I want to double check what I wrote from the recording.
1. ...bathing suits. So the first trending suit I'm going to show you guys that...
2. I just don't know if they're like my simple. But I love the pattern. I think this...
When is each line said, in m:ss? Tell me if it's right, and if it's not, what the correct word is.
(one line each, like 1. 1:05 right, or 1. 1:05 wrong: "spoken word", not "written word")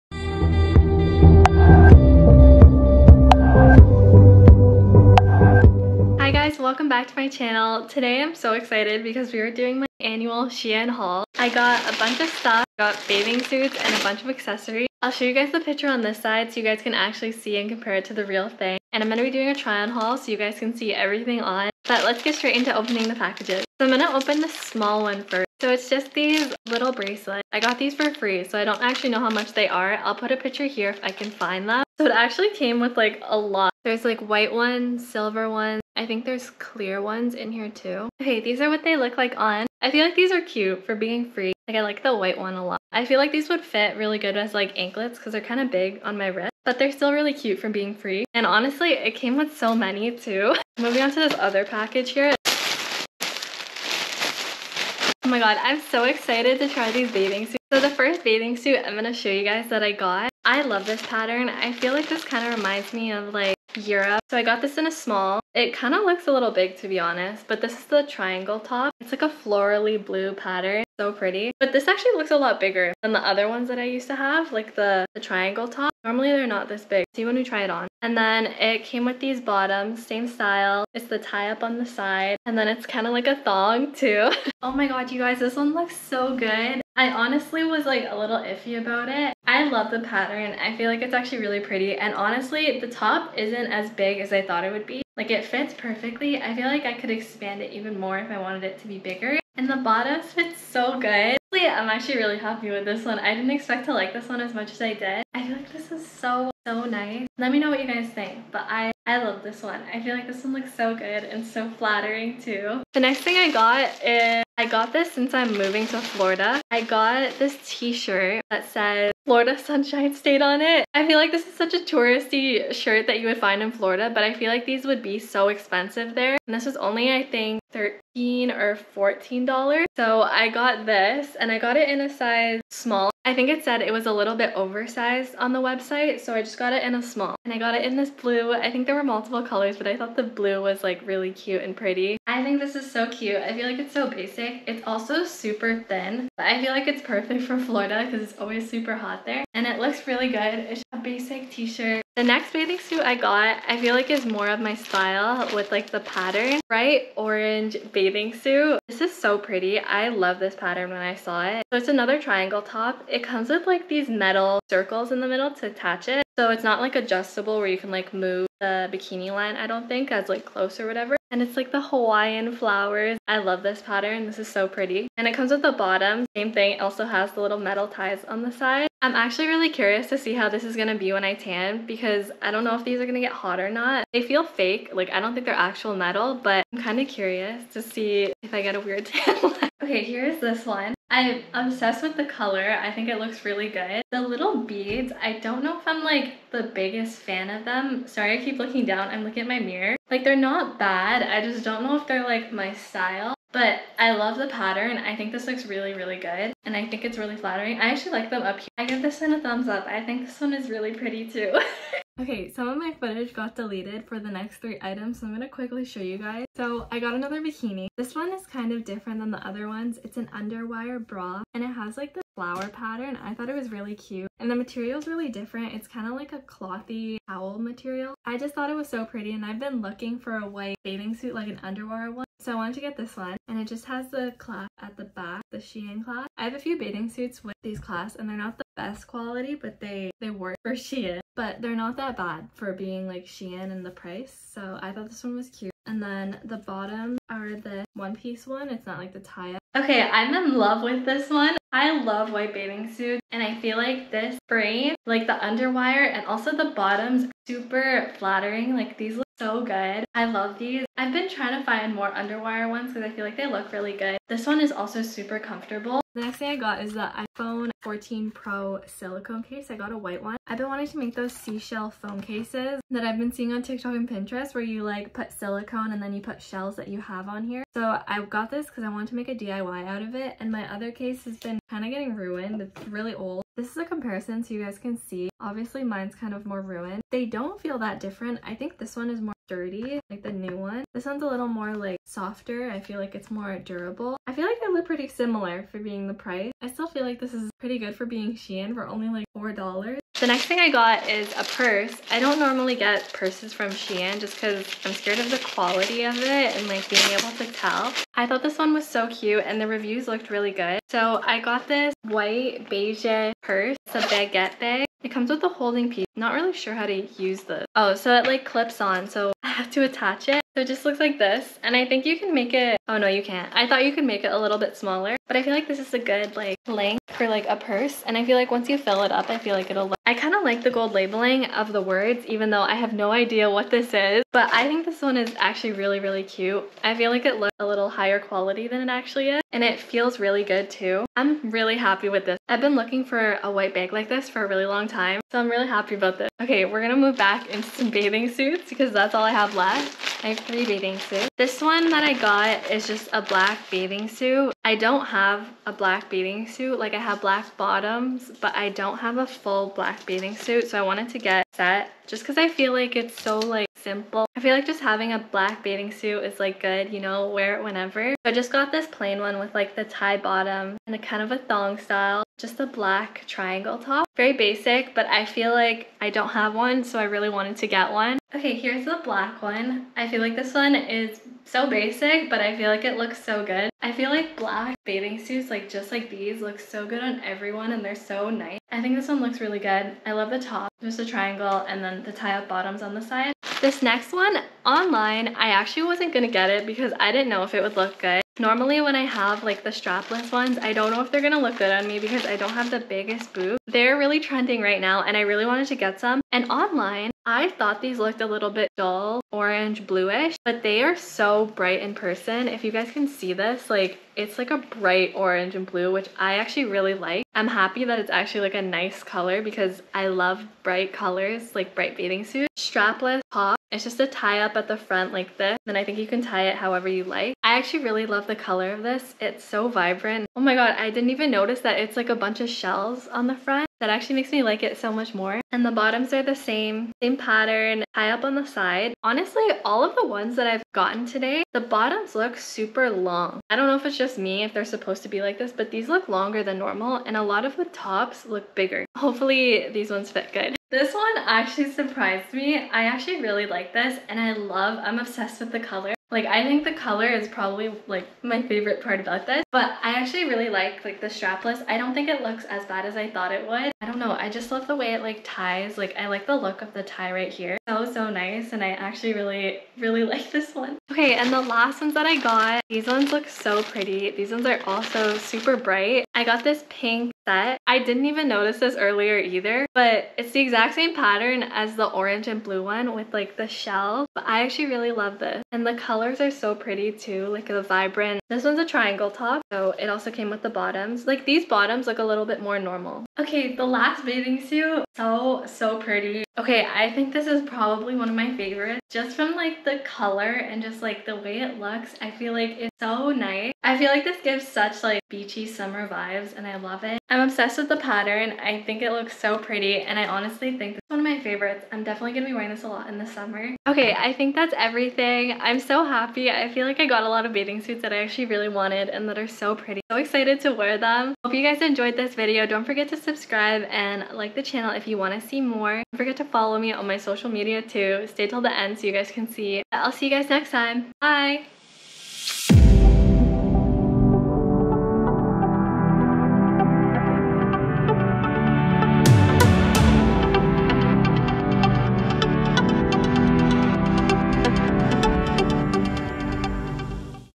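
1. 0:57 wrong: "bathing", not "trending"
2. 3:21 wrong: "style", not "simple".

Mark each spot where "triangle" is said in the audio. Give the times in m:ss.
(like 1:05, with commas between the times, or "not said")
1:08, 1:15, 2:42, 6:13, 6:31, 8:08.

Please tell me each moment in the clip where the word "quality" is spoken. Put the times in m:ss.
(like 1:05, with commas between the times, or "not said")
3:59, 5:05, 5:38.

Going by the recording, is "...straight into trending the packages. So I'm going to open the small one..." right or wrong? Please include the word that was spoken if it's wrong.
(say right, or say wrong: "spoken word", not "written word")
wrong: "opening", not "trending".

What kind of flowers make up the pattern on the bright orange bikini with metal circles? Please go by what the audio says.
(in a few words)
Hawaiian flowers.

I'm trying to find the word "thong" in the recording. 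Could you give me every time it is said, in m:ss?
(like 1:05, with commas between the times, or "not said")
1:23, 6:11.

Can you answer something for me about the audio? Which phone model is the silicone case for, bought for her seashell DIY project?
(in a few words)
iPhone 14 Pro.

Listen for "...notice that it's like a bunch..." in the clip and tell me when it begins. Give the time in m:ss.
7:11.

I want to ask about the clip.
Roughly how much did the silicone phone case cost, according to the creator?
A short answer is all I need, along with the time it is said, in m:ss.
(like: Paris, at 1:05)
$4, at 4:58.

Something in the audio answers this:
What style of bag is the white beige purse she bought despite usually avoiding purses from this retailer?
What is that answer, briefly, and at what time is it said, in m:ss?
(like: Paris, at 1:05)
Baguette bag, at 5:14.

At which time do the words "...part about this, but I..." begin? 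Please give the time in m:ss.
7:38.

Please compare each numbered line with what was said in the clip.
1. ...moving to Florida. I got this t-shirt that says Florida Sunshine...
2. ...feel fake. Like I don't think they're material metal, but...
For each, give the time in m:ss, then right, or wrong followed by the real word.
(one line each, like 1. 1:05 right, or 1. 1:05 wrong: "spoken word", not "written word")
1. 1:55 right
2. 3:04 wrong: "actual", not "material".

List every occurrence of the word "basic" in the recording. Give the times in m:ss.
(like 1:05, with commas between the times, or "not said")
2:24, 2:30, 6:14, 6:21.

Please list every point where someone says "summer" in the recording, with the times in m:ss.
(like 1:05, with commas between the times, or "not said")
8:25, 8:33.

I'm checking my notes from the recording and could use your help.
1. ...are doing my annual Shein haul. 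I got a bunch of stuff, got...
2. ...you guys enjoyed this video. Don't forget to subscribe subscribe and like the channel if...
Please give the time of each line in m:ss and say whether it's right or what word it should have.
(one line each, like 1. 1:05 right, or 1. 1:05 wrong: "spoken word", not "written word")
1. 0:09 right
2. 8:41 right.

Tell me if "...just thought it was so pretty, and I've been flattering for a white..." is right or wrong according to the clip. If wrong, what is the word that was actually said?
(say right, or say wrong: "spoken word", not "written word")
wrong: "looking", not "flattering".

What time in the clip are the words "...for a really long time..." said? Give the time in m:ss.
5:44.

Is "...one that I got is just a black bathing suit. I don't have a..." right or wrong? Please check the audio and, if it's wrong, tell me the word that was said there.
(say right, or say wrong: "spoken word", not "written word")
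right.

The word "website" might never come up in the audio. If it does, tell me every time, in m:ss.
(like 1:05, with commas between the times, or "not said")
2:15.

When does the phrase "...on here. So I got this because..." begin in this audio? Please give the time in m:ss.
4:37.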